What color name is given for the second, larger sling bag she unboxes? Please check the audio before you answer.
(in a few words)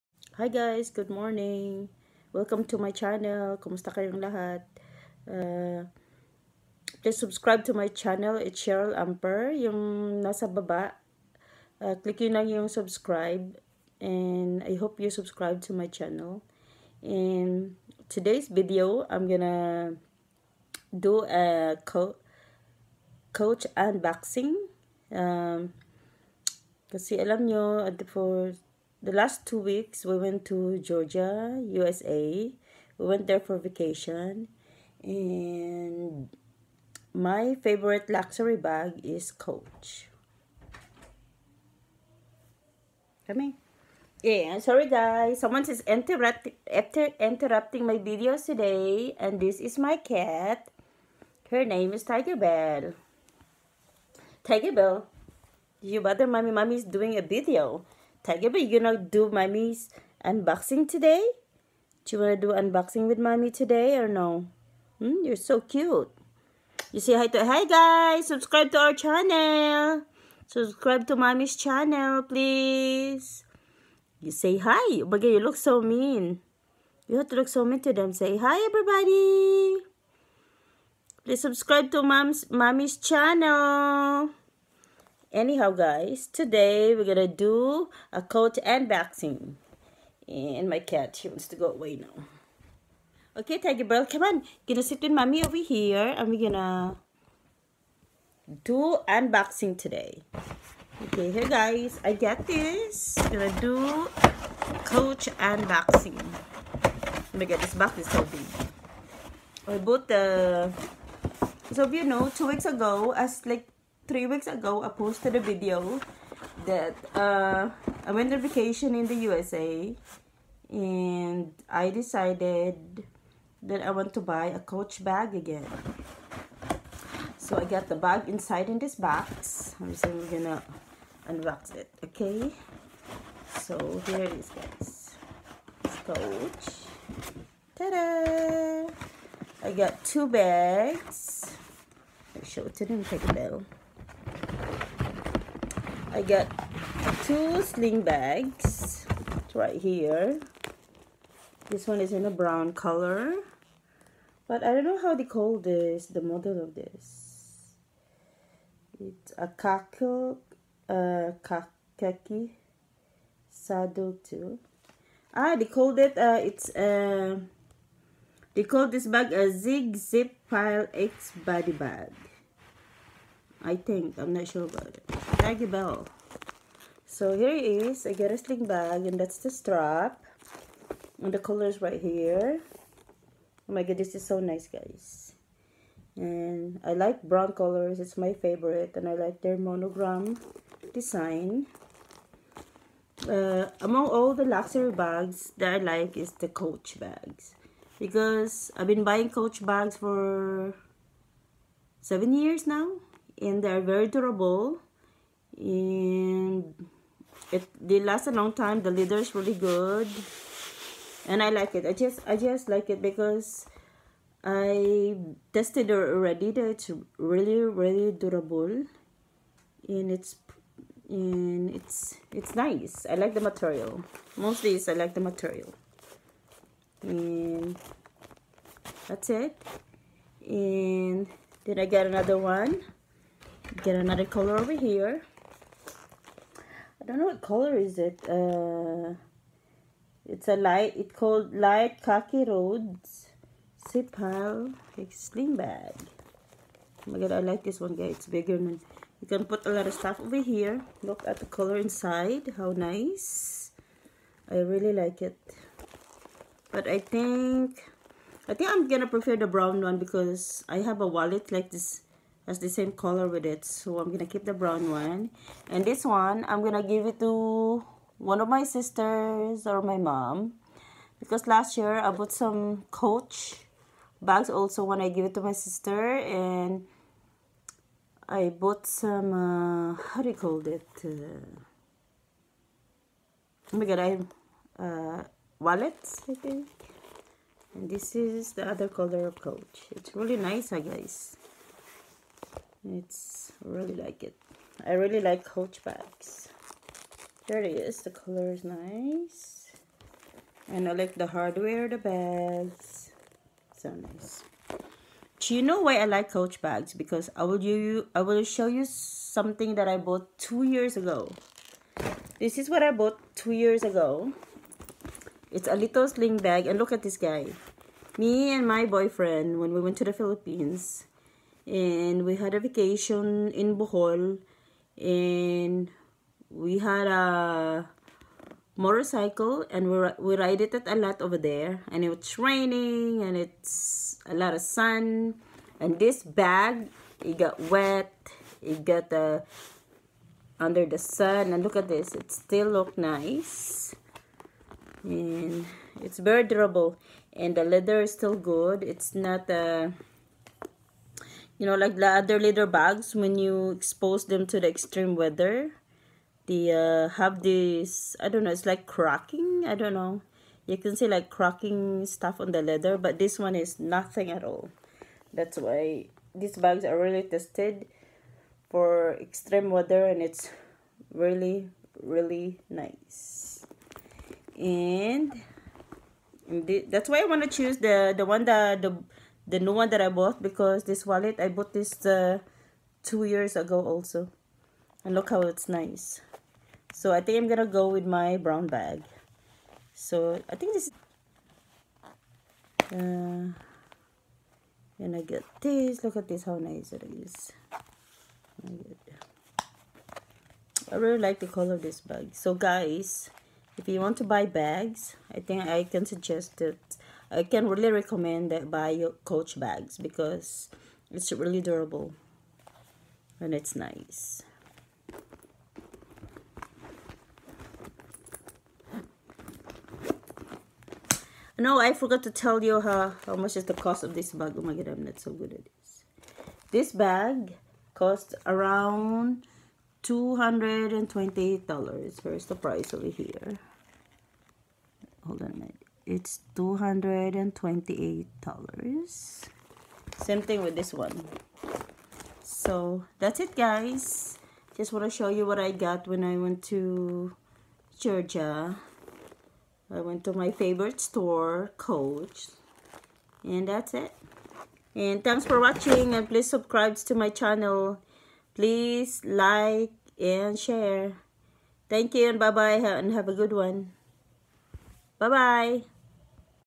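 light khaki.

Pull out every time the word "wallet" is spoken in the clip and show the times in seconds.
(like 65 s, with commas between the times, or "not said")
261 s, 285 s, 381 s.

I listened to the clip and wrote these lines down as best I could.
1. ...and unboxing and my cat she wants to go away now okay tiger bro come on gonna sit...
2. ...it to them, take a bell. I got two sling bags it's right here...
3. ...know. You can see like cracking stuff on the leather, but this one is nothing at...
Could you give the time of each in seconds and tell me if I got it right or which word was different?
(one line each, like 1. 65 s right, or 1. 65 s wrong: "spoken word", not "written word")
1. 88 s right
2. 142 s right
3. 359 s right.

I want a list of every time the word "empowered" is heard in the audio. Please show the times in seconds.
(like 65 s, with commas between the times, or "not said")
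not said.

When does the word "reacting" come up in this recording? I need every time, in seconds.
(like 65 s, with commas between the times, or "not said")
not said.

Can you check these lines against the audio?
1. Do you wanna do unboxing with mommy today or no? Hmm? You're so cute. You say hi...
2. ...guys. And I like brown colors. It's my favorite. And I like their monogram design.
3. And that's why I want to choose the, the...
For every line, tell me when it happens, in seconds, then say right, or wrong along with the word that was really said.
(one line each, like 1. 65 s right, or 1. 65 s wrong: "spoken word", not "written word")
1. 62 s right
2. 184 s right
3. 374 s right.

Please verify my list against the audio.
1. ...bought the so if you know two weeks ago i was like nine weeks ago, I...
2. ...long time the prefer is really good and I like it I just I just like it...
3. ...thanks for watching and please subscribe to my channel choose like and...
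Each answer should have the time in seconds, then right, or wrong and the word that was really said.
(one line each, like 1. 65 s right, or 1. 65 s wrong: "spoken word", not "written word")
1. 109 s wrong: "three", not "nine"
2. 208 s wrong: "leather", not "prefer"
3. 455 s wrong: "please", not "choose".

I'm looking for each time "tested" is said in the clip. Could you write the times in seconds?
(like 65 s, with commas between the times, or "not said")
215 s, 367 s.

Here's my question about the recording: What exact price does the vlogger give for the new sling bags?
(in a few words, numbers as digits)
$228.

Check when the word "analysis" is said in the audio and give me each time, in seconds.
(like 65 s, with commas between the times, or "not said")
not said.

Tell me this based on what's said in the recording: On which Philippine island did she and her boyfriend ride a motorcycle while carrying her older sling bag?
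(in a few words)
Bohol.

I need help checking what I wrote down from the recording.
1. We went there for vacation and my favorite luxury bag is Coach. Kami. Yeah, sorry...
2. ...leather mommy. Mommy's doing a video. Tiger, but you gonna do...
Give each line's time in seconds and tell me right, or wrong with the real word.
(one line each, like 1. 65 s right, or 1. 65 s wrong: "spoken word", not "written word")
1. 32 s right
2. 56 s wrong: "bother", not "leather".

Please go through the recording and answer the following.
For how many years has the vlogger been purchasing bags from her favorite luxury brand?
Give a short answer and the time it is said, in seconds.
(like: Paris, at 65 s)
7 years, at 202 s.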